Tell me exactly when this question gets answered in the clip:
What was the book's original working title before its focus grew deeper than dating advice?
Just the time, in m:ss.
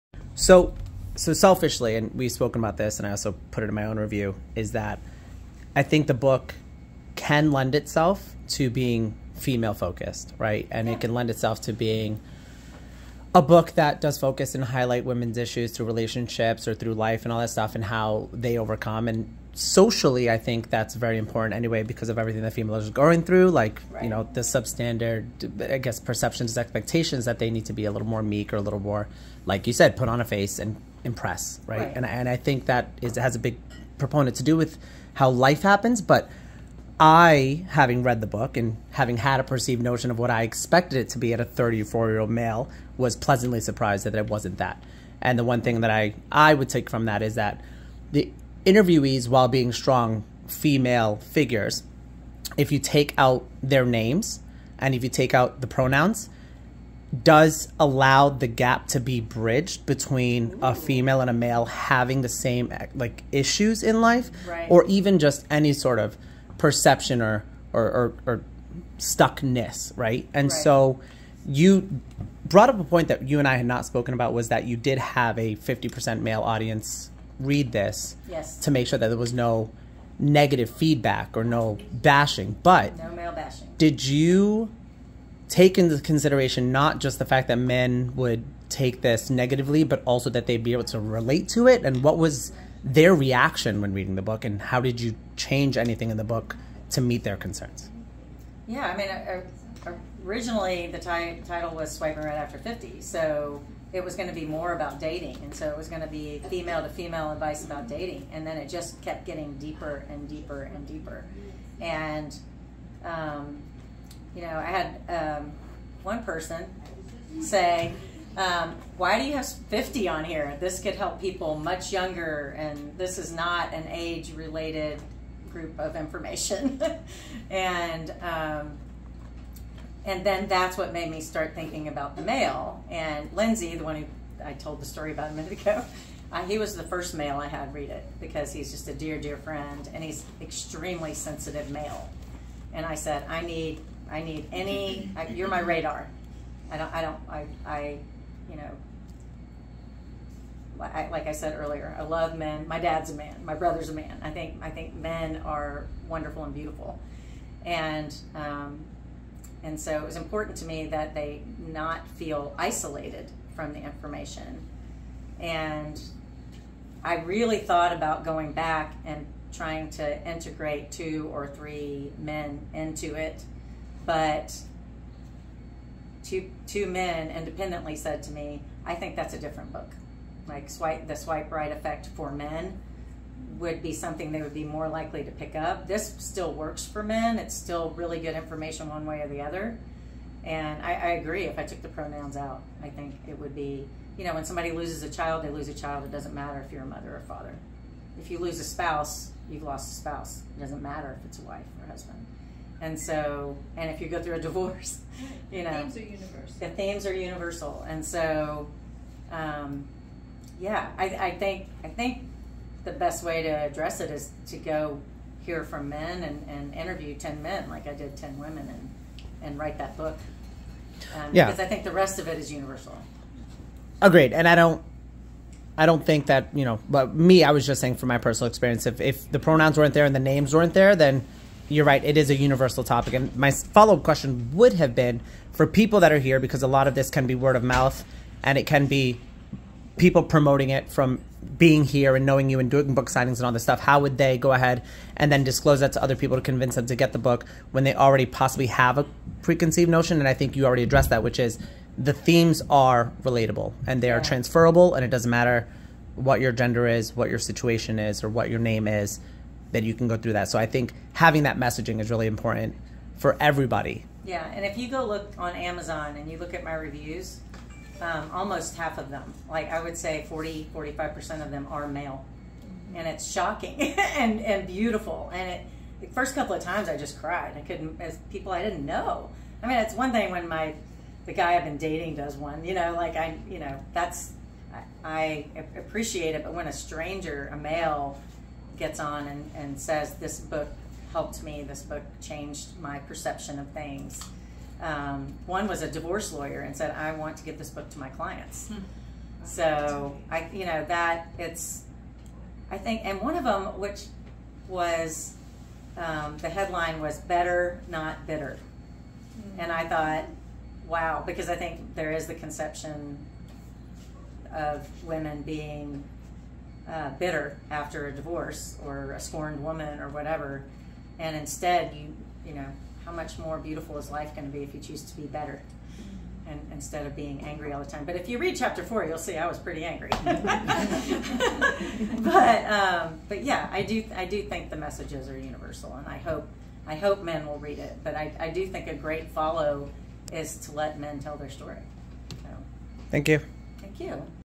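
1:41.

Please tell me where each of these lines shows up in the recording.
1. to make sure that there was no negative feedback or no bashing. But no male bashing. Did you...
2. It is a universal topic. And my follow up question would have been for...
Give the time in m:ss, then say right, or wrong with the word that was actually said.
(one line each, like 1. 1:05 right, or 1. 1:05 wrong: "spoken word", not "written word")
1. 1:18 right
2. 3:52 right.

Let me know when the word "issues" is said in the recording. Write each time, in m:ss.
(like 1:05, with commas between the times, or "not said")
0:15, 1:03.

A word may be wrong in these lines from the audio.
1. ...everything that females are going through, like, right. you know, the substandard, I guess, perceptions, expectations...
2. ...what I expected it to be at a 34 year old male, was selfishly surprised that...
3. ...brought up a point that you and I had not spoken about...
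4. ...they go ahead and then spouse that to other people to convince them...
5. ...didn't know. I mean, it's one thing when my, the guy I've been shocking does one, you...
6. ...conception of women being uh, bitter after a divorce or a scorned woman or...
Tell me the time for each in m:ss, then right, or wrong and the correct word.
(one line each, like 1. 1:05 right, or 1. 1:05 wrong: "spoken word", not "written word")
1. 0:22 right
2. 0:40 wrong: "pleasantly", not "selfishly"
3. 1:12 right
4. 4:04 wrong: "disclose", not "spouse"
5. 4:38 wrong: "dating", not "shocking"
6. 5:12 right.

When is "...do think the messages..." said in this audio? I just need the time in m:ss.
5:34.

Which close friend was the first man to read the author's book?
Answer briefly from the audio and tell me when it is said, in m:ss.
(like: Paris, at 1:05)
Lindsay, at 2:13.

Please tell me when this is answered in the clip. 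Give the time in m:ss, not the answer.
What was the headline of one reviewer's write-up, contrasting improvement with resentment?
5:07.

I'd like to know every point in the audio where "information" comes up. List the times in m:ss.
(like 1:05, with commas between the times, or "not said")
2:05, 2:43, 3:08.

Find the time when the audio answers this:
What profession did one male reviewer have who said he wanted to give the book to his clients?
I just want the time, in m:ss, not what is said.
4:55.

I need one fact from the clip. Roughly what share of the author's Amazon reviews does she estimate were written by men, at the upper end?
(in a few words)
45%.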